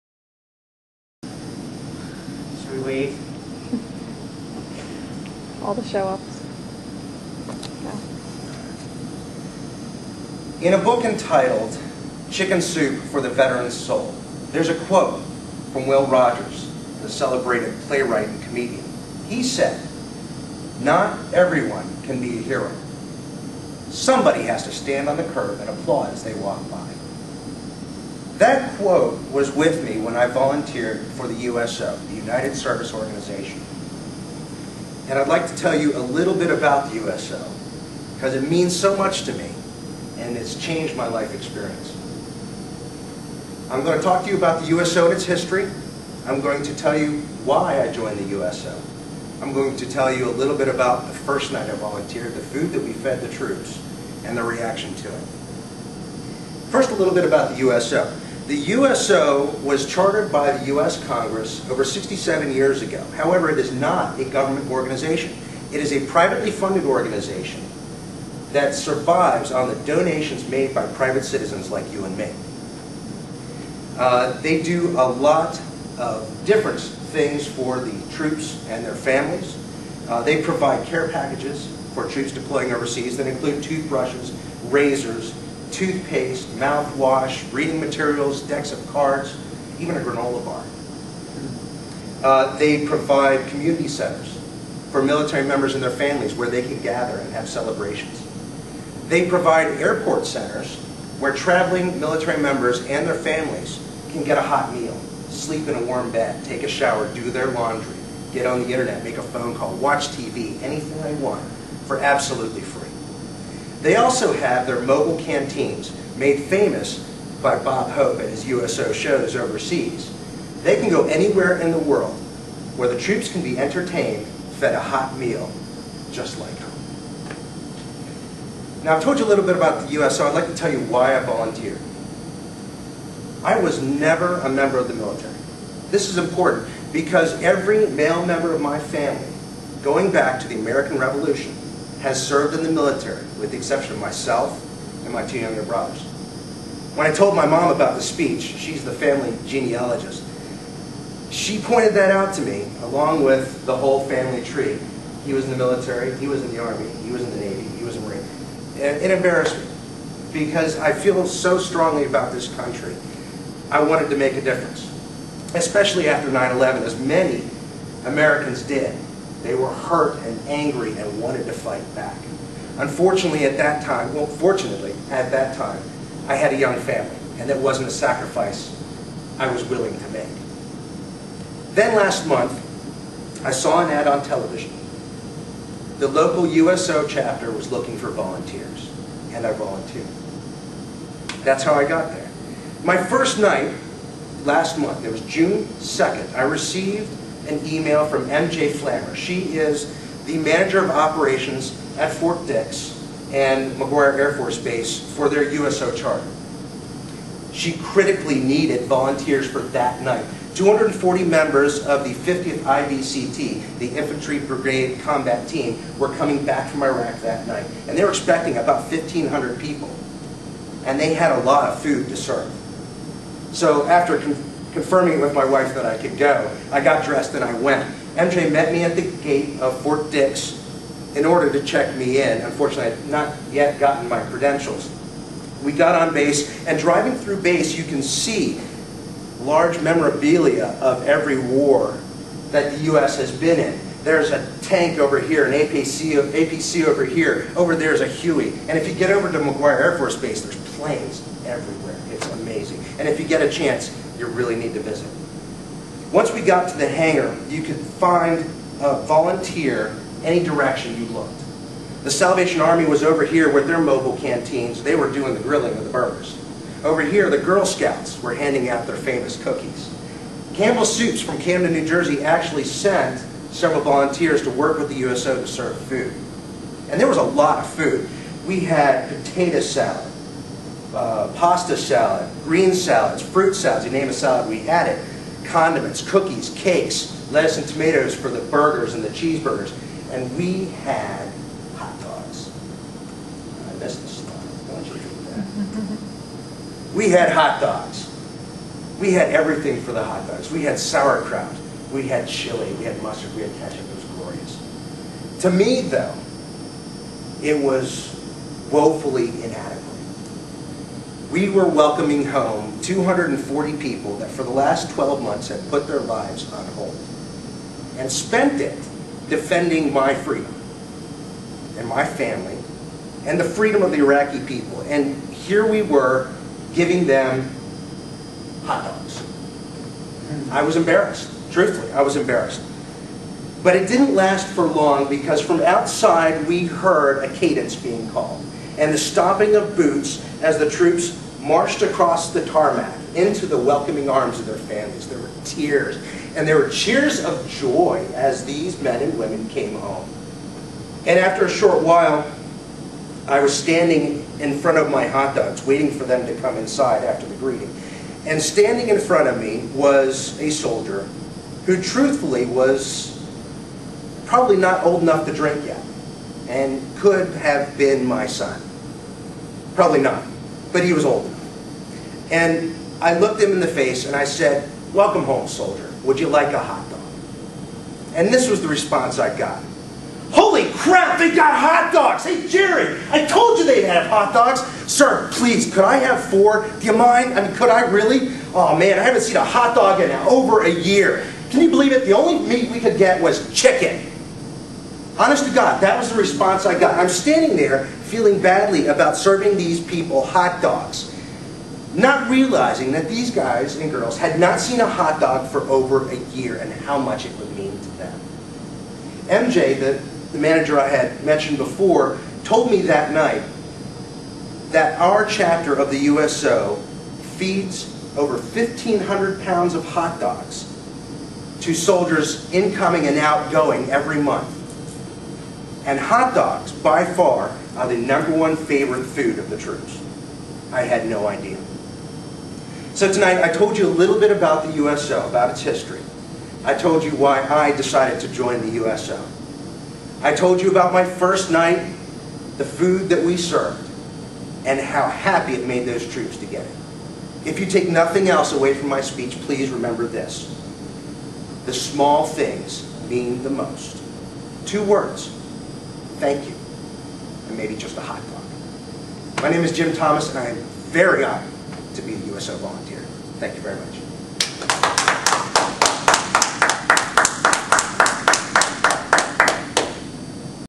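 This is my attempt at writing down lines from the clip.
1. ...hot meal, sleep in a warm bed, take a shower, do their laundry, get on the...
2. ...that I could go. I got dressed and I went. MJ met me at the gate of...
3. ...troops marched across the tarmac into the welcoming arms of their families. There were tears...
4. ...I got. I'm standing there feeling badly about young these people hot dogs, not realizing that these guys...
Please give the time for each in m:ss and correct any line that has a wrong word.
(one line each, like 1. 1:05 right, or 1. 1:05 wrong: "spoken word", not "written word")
1. 1:44 right
2. 3:45 right
3. 5:40 right
4. 6:36 wrong: "serving", not "young".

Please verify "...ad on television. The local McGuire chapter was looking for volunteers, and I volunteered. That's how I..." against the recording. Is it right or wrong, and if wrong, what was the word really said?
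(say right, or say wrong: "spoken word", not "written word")
wrong: "USO", not "McGuire".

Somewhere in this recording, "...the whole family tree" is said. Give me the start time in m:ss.
2:33.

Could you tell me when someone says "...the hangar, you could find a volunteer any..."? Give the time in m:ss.
4:16.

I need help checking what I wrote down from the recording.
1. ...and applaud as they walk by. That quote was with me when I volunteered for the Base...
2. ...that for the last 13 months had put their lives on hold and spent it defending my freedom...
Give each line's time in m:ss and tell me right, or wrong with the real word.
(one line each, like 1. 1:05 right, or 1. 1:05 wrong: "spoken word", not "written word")
1. 0:25 wrong: "USO", not "Base"
2. 5:14 wrong: "12", not "13".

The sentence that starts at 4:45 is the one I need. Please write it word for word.
Condiments, cookies, cakes, lettuce and tomatoes for the burgers and the cheeseburgers.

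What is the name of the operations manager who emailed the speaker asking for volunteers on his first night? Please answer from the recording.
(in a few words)
MJ Flammer.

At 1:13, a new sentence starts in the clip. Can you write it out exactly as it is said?
Uh, they do a lot of different things for the troops and their families.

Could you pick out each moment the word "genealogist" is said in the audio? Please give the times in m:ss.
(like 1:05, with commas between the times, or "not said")
2:29.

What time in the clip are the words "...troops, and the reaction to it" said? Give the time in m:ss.
0:53.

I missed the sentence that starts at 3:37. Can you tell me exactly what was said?
And they were expecting about 1,500 people.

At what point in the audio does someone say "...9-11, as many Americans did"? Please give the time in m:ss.
2:46.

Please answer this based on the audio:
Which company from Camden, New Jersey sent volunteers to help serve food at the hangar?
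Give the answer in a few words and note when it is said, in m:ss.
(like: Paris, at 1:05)
Campbell Soups, at 4:30.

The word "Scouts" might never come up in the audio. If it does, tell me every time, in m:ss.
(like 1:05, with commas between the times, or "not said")
4:27.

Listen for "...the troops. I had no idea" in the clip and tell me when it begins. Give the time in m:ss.
7:09.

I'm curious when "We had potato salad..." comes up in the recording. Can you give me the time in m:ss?
4:38.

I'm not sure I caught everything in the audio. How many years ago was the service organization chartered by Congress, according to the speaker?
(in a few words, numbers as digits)
67.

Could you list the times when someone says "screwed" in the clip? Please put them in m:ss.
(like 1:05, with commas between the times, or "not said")
not said.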